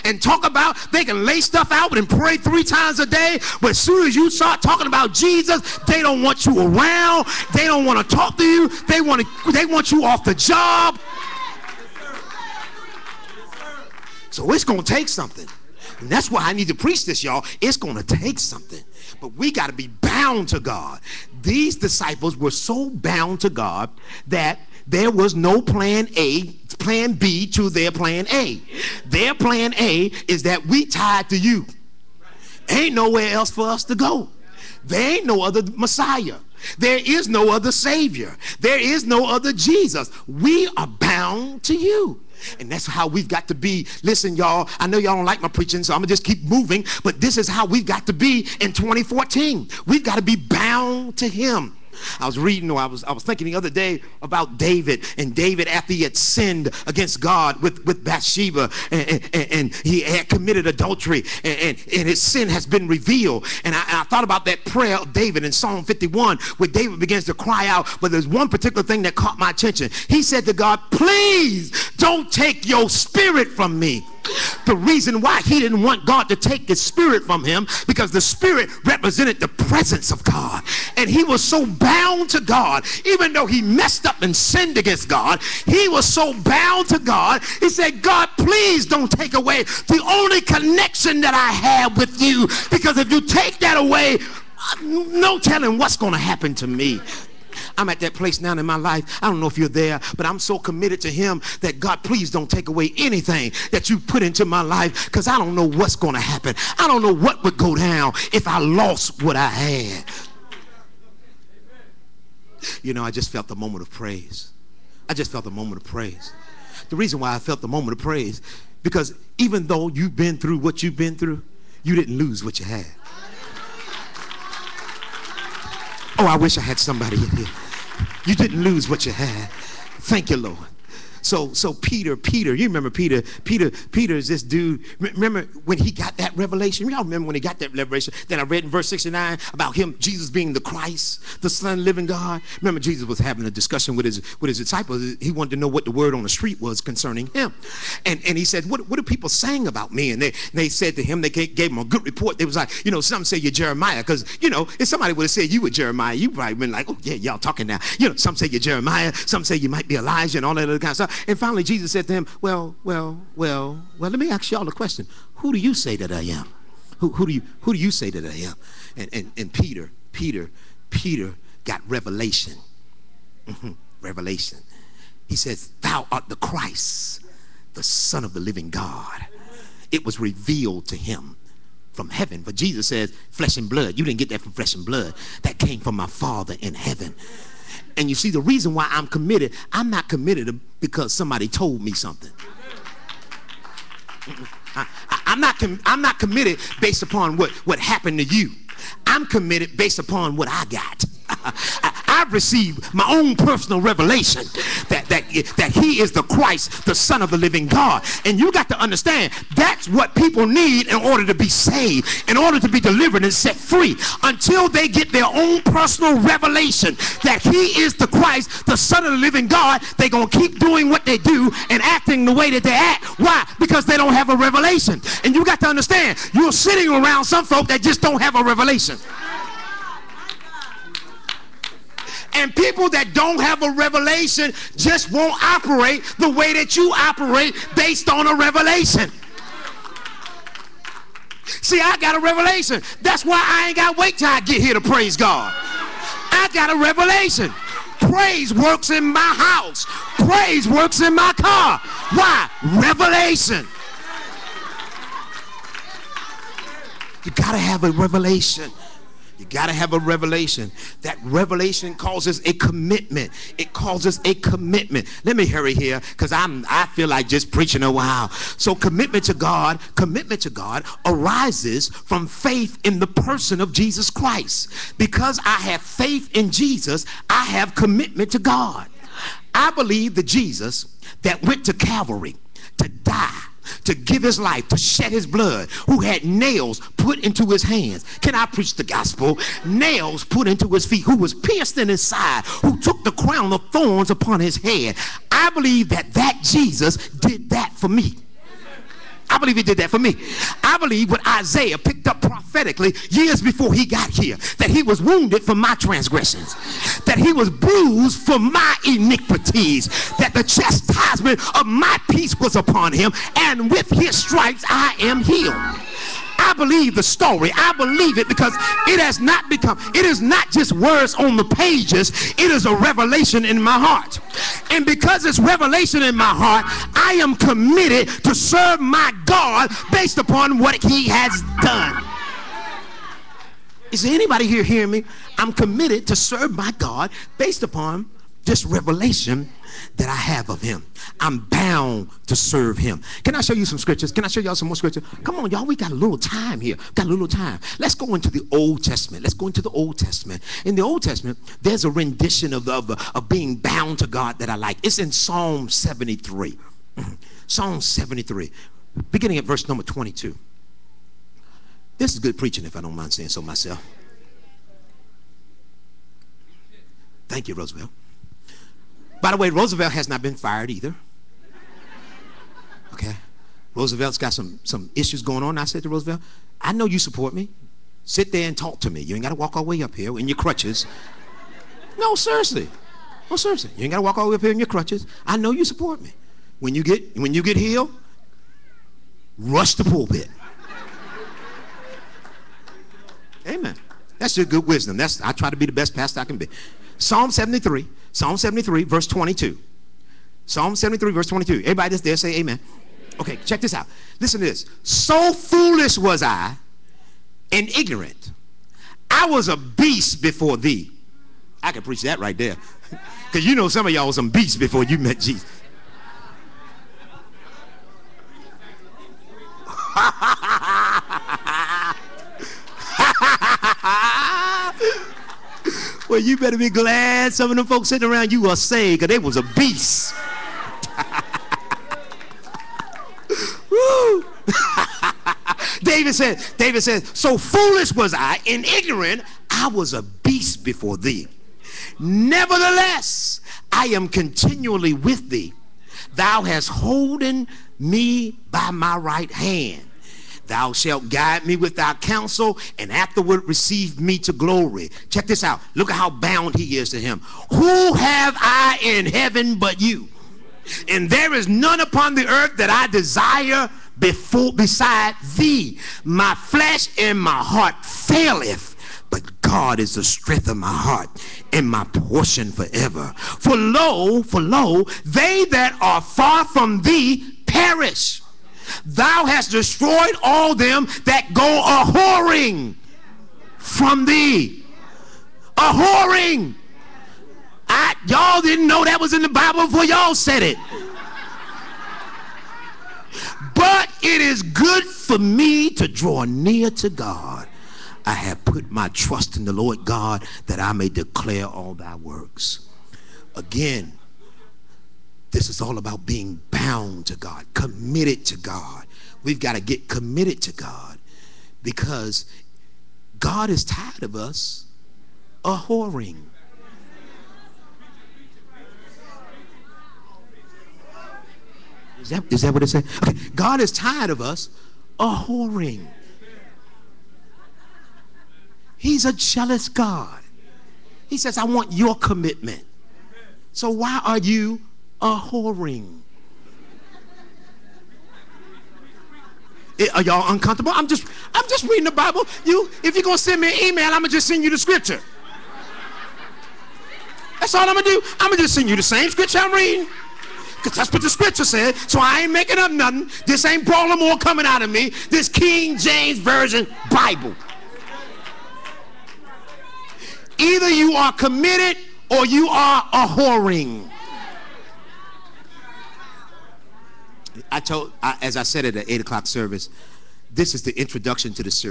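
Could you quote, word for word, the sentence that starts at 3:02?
But Jesus says, Flesh and blood.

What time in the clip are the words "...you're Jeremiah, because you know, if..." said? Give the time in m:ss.
2:33.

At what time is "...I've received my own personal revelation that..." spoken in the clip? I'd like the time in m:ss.
3:22.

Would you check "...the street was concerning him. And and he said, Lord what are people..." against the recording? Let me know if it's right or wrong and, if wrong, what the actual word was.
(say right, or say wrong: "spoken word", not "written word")
wrong: "What", not "Lord".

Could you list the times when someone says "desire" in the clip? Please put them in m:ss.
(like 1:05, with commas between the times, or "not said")
7:42.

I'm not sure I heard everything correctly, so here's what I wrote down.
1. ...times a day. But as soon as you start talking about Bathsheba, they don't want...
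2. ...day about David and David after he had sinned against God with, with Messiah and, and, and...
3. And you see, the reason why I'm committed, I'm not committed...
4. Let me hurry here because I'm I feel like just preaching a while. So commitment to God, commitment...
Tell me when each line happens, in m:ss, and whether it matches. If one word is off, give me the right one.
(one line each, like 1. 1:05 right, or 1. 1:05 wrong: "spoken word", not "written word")
1. 0:02 wrong: "Jesus", not "Bathsheba"
2. 0:53 wrong: "Bathsheba", not "Messiah"
3. 3:07 right
4. 4:25 right.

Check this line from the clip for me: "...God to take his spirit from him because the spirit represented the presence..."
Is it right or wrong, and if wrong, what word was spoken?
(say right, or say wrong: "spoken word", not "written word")
right.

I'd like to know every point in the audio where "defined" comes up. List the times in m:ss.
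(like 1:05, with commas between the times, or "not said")
not said.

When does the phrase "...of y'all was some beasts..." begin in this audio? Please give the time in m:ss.
6:53.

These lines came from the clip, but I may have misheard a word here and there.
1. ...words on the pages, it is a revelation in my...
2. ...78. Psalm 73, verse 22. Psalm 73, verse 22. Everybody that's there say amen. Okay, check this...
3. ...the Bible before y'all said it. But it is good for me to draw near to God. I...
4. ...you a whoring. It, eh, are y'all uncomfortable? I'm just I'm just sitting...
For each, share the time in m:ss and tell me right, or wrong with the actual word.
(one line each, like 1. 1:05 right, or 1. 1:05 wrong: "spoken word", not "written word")
1. 5:20 right
2. 6:37 wrong: "73", not "78"
3. 8:09 right
4. 8:54 wrong: "reading", not "sitting".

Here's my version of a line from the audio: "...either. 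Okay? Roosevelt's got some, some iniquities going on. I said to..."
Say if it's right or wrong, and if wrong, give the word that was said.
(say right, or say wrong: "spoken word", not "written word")
wrong: "issues", not "iniquities".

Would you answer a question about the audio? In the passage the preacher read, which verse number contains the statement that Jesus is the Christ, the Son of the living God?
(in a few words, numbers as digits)
69.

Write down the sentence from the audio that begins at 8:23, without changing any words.
Again, this is all about being bound to God, committed to God.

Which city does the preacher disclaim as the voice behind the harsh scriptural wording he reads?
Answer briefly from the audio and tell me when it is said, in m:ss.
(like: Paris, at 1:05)
Baltimore, at 9:13.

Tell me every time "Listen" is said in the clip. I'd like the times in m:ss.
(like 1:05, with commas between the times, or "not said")
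0:44, 6:44.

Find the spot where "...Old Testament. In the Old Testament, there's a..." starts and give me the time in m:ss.
5:49.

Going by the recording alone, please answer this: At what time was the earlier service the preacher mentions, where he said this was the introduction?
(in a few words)
8 o'clock.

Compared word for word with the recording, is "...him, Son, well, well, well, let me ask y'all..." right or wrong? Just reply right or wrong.
wrong.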